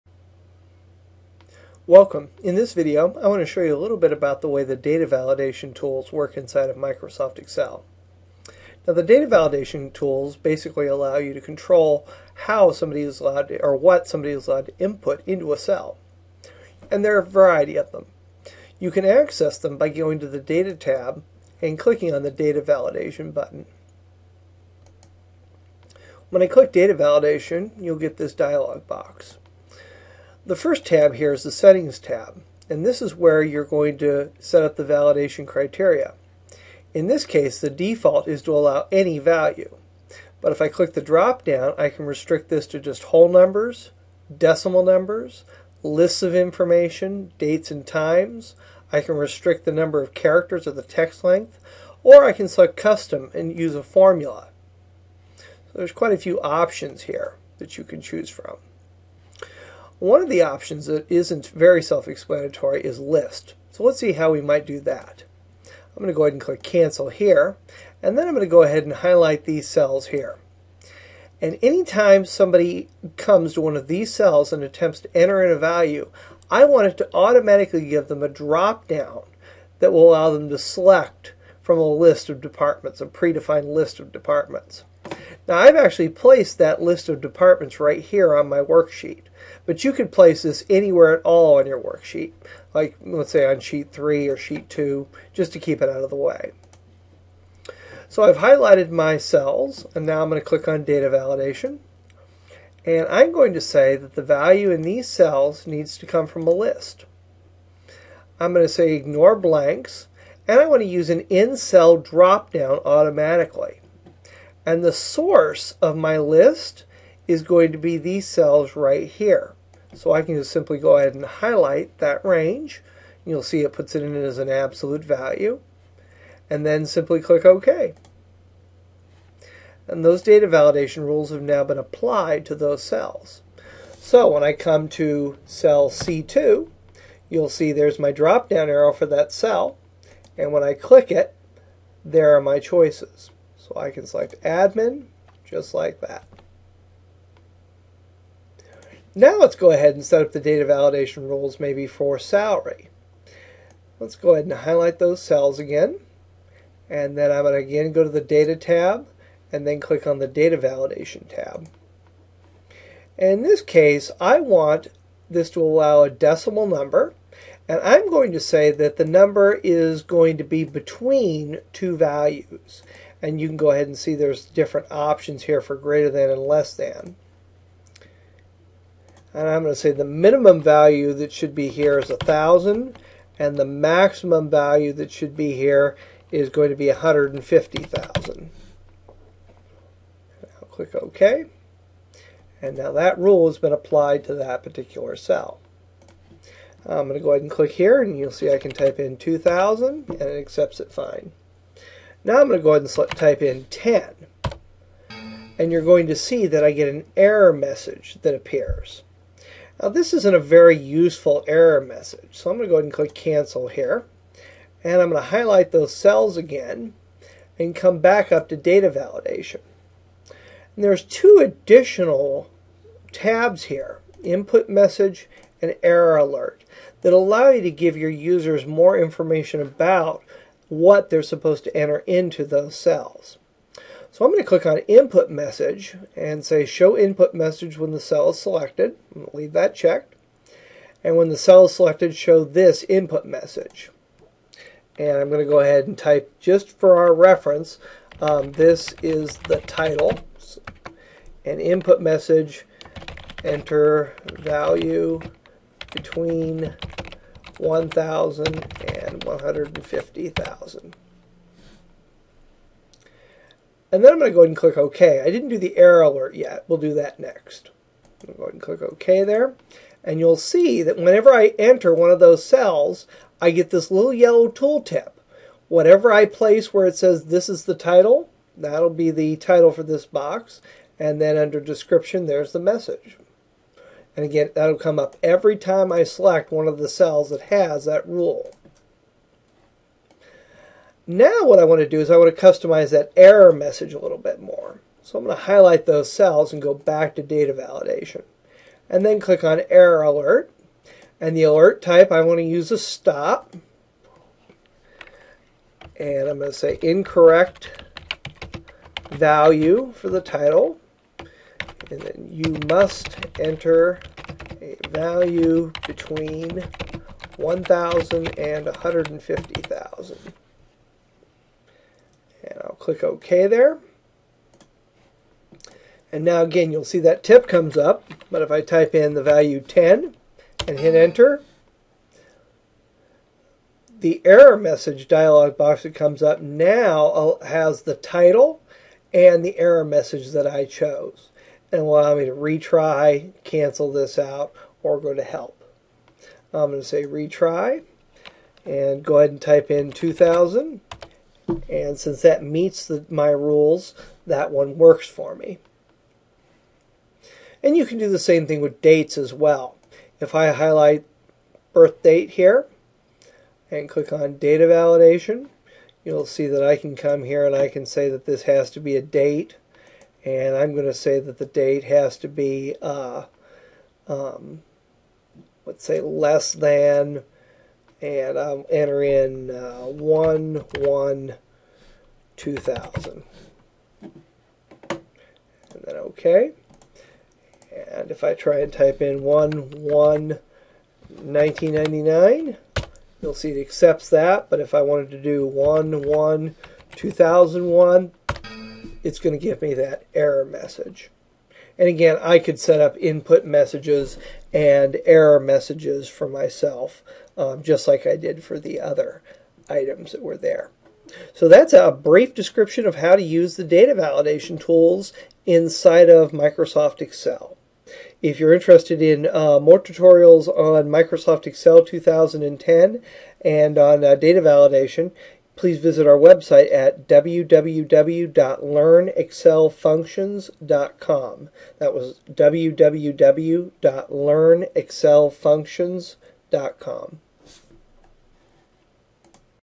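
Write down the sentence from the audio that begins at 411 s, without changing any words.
So that's a brief description of how to use the data validation tools inside of Microsoft Excel.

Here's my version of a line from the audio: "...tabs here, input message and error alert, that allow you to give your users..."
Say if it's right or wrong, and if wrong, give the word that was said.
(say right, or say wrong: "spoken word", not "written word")
right.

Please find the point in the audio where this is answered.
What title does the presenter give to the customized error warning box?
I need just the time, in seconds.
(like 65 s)
306 s.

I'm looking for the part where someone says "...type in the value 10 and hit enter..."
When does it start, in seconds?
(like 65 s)
328 s.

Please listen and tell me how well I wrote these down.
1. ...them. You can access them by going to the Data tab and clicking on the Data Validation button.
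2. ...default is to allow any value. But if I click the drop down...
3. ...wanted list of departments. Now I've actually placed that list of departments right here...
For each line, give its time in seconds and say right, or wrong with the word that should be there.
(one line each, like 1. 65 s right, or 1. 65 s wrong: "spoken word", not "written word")
1. 17 s right
2. 37 s right
3. 83 s wrong: "predefined", not "wanted".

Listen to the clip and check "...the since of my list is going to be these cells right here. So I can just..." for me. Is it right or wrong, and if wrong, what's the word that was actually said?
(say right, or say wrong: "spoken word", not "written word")
wrong: "source", not "since".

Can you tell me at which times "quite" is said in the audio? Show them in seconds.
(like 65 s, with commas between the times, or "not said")
55 s.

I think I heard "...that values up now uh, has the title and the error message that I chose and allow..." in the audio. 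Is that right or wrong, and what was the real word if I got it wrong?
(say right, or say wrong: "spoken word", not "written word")
wrong: "comes", not "values".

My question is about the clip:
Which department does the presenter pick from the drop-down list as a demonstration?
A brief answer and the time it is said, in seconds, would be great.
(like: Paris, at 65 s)
admin, at 143 s.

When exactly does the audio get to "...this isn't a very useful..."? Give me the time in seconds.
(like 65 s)
209 s.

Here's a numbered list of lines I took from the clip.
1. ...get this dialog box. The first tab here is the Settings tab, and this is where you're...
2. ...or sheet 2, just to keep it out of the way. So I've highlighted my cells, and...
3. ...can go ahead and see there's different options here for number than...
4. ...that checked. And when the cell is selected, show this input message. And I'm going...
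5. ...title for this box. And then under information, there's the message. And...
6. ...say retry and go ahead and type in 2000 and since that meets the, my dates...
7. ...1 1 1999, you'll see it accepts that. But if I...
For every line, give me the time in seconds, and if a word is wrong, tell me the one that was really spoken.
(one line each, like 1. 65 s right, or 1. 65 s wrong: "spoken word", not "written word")
1. 27 s right
2. 94 s right
3. 173 s wrong: "greater", not "number"
4. 239 s right
5. 279 s wrong: "description", not "information"
6. 346 s wrong: "rules", not "dates"
7. 389 s right.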